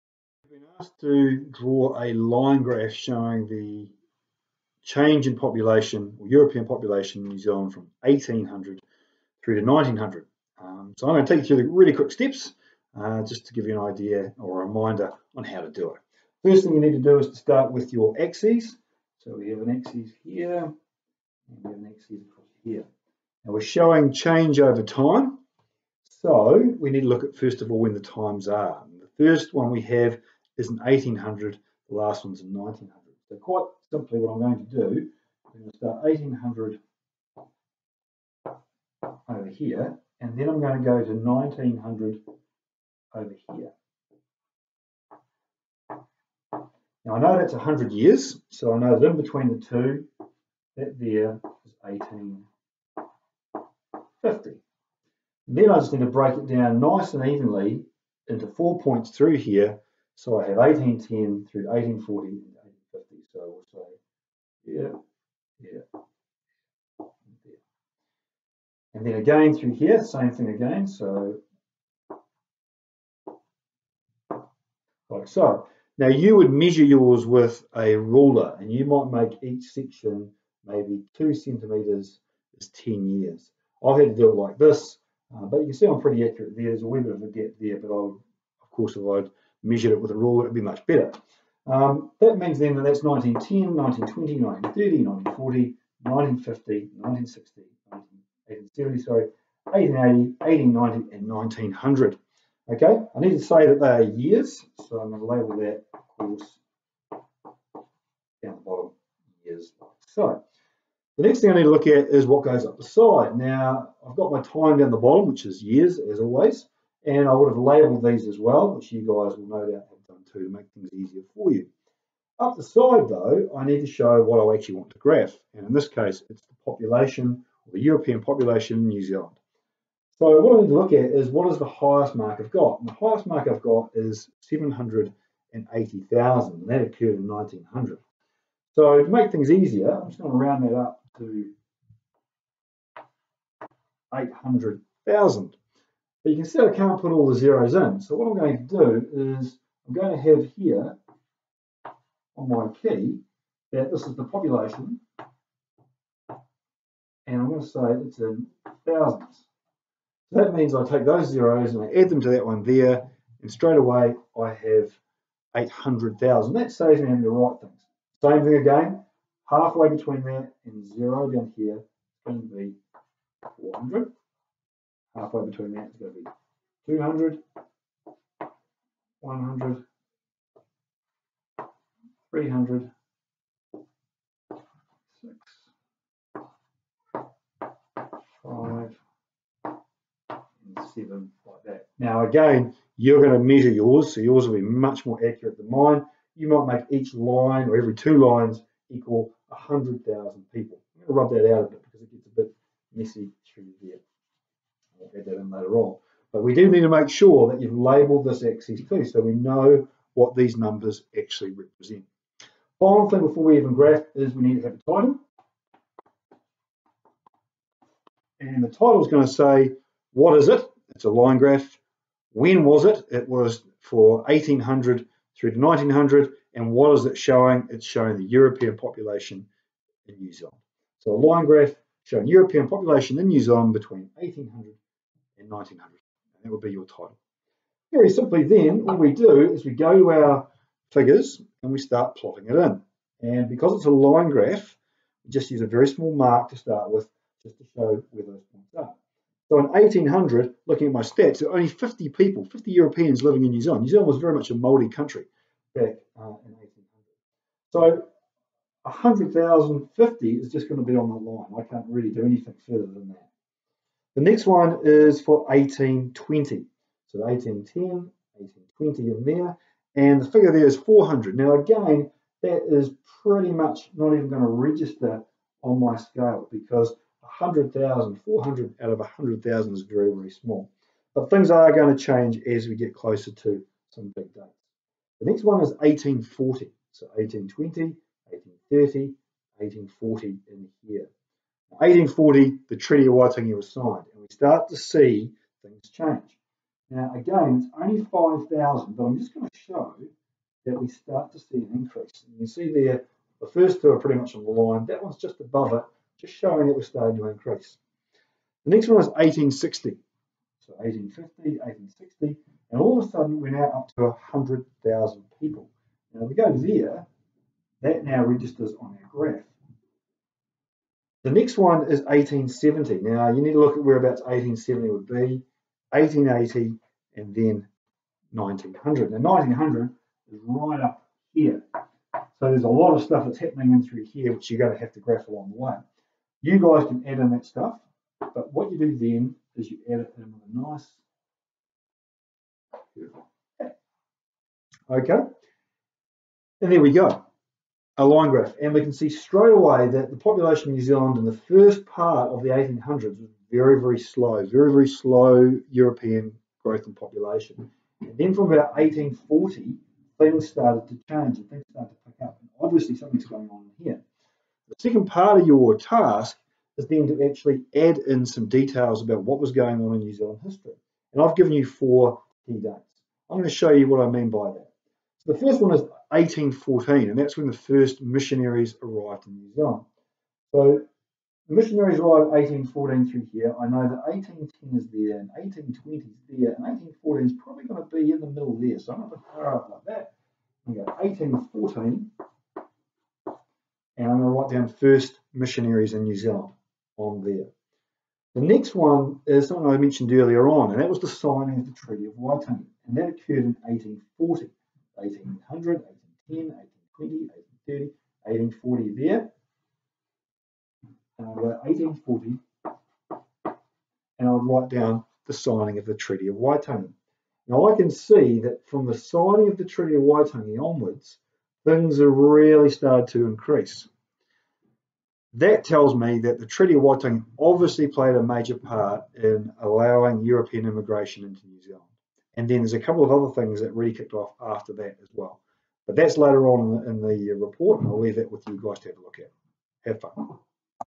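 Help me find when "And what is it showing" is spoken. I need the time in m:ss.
3:46.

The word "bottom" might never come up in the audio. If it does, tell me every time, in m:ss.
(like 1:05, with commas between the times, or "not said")
1:48, 1:54.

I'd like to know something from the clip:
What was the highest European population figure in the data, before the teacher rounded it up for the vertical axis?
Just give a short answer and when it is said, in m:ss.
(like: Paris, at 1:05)
780,000, at 2:14.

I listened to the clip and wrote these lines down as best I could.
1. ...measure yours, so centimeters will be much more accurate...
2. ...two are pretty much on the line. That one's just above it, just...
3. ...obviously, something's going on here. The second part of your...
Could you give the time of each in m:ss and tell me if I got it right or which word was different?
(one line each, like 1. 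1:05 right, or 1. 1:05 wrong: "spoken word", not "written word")
1. 3:13 wrong: "yours", not "centimeters"
2. 5:03 right
3. 6:02 right.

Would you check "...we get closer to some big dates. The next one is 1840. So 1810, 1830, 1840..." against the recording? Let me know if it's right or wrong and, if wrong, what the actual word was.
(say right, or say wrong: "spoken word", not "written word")
wrong: "1820", not "1810".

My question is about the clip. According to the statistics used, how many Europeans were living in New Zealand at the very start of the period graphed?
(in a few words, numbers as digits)
50.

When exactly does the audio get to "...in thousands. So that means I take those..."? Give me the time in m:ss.
2:38.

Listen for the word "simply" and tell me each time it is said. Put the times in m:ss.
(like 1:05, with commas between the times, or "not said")
0:33, 3:58.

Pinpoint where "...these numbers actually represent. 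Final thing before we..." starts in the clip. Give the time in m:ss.
3:30.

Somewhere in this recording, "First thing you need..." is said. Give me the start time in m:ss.
0:16.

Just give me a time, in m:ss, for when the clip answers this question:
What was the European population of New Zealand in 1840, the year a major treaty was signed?
4:58.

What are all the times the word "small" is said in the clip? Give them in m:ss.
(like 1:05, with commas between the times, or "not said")
4:05, 4:40.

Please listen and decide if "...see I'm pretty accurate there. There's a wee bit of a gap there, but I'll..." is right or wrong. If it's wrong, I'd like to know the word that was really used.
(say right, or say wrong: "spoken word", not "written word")
right.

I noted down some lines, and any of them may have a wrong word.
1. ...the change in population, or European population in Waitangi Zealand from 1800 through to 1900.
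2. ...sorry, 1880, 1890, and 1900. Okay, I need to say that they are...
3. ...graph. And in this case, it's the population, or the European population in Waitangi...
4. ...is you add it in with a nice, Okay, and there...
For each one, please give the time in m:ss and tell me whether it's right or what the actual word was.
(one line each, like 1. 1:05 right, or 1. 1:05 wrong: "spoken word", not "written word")
1. 0:03 wrong: "New", not "Waitangi"
2. 1:38 right
3. 2:04 wrong: "New", not "Waitangi"
4. 5:39 right.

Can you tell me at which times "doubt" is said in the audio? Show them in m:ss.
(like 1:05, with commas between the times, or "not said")
1:59.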